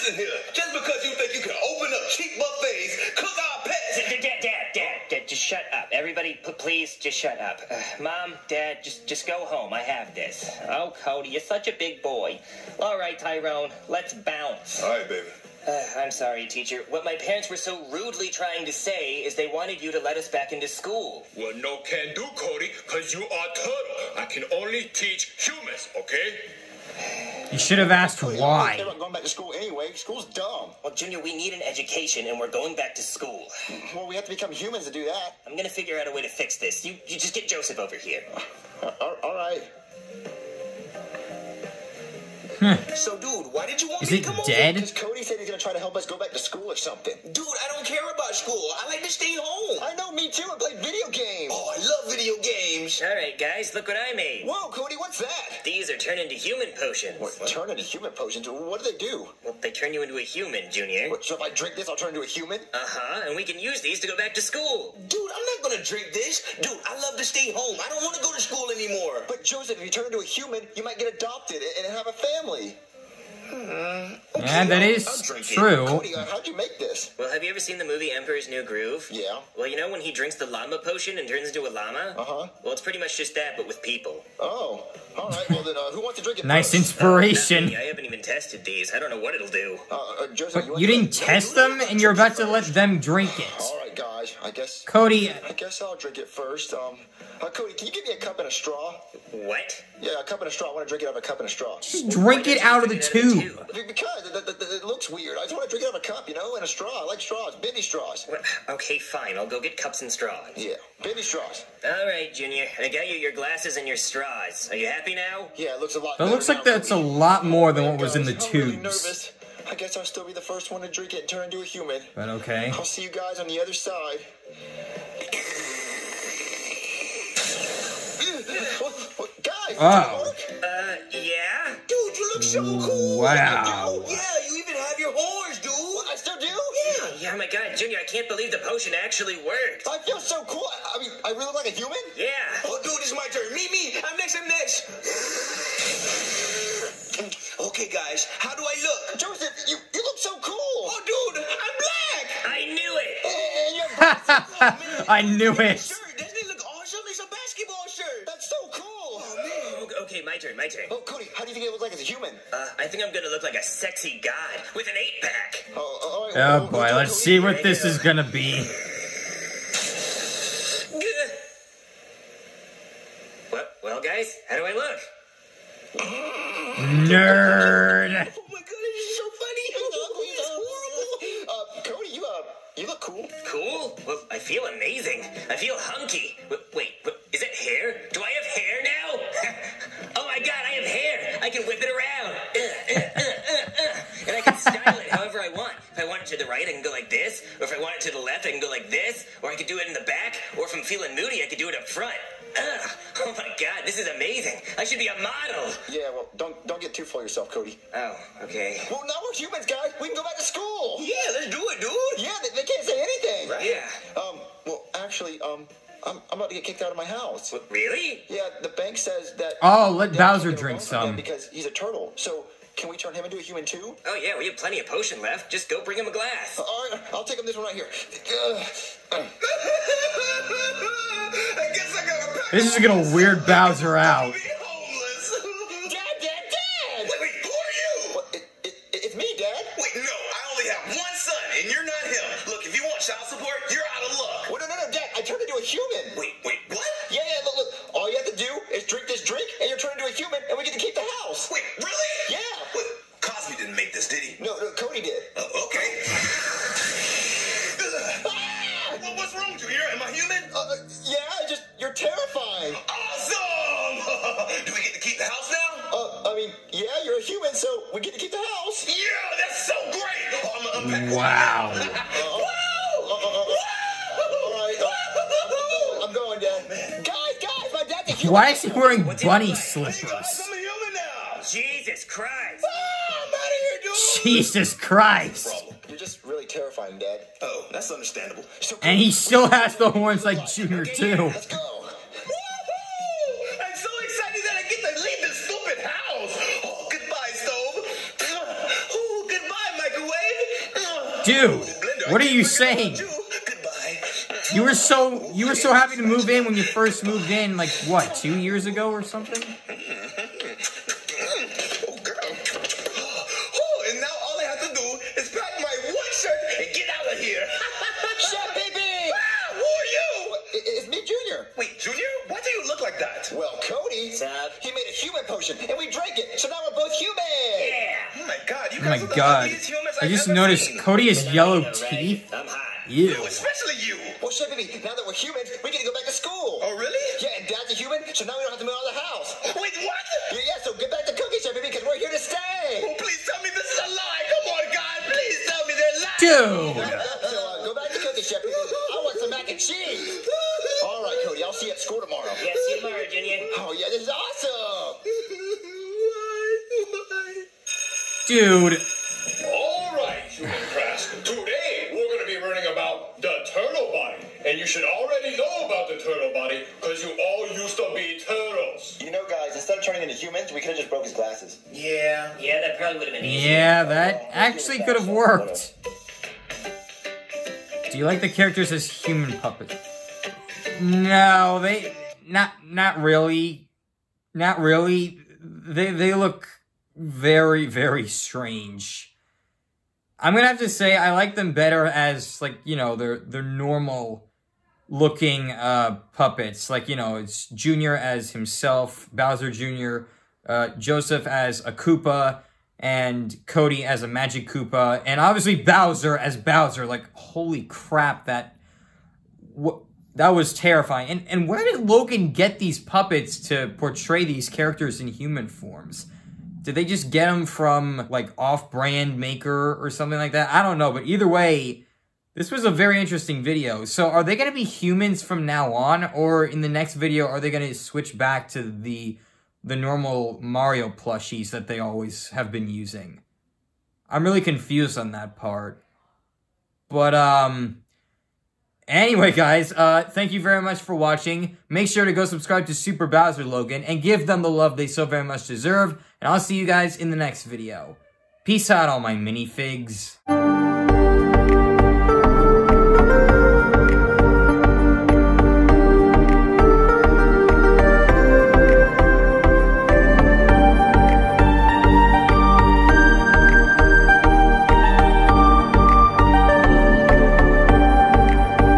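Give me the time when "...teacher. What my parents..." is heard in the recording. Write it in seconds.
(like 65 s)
16 s.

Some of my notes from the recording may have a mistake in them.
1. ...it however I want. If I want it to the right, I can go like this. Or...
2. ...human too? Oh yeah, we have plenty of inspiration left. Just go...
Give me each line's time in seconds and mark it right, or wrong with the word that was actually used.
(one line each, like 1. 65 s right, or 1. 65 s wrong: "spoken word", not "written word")
1. 194 s right
2. 223 s wrong: "potion", not "inspiration".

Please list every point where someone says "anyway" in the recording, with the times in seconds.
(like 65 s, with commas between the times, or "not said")
29 s, 438 s.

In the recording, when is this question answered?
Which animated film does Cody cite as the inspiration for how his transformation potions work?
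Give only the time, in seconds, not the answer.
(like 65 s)
78 s.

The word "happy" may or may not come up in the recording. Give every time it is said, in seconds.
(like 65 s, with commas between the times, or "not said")
114 s, 305 s.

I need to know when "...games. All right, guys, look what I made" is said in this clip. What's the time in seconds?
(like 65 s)
52 s.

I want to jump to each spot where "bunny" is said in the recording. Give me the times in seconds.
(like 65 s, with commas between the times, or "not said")
279 s.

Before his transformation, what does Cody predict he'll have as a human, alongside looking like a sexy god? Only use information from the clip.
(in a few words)
an eight-pack.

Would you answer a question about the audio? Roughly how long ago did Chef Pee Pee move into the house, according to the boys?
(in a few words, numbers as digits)
2 years.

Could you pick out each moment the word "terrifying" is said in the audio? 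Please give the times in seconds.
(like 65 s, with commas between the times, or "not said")
286 s, 410 s.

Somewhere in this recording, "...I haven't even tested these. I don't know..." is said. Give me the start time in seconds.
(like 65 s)
87 s.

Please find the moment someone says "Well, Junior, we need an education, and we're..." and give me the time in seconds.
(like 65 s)
30 s.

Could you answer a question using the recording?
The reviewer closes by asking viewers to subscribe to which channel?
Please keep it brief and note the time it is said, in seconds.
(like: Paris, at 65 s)
Super Bowser Logan, at 442 s.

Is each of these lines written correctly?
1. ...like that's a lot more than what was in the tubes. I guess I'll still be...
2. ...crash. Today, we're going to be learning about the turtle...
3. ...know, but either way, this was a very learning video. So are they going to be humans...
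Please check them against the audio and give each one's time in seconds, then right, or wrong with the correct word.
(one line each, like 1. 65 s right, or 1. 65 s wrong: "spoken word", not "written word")
1. 116 s right
2. 360 s right
3. 420 s wrong: "interesting", not "learning".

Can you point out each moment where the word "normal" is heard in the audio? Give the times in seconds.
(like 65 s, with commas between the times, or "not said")
393 s, 429 s.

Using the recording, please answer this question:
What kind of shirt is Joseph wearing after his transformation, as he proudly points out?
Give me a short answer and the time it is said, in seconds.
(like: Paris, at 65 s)
a basketball shirt, at 157 s.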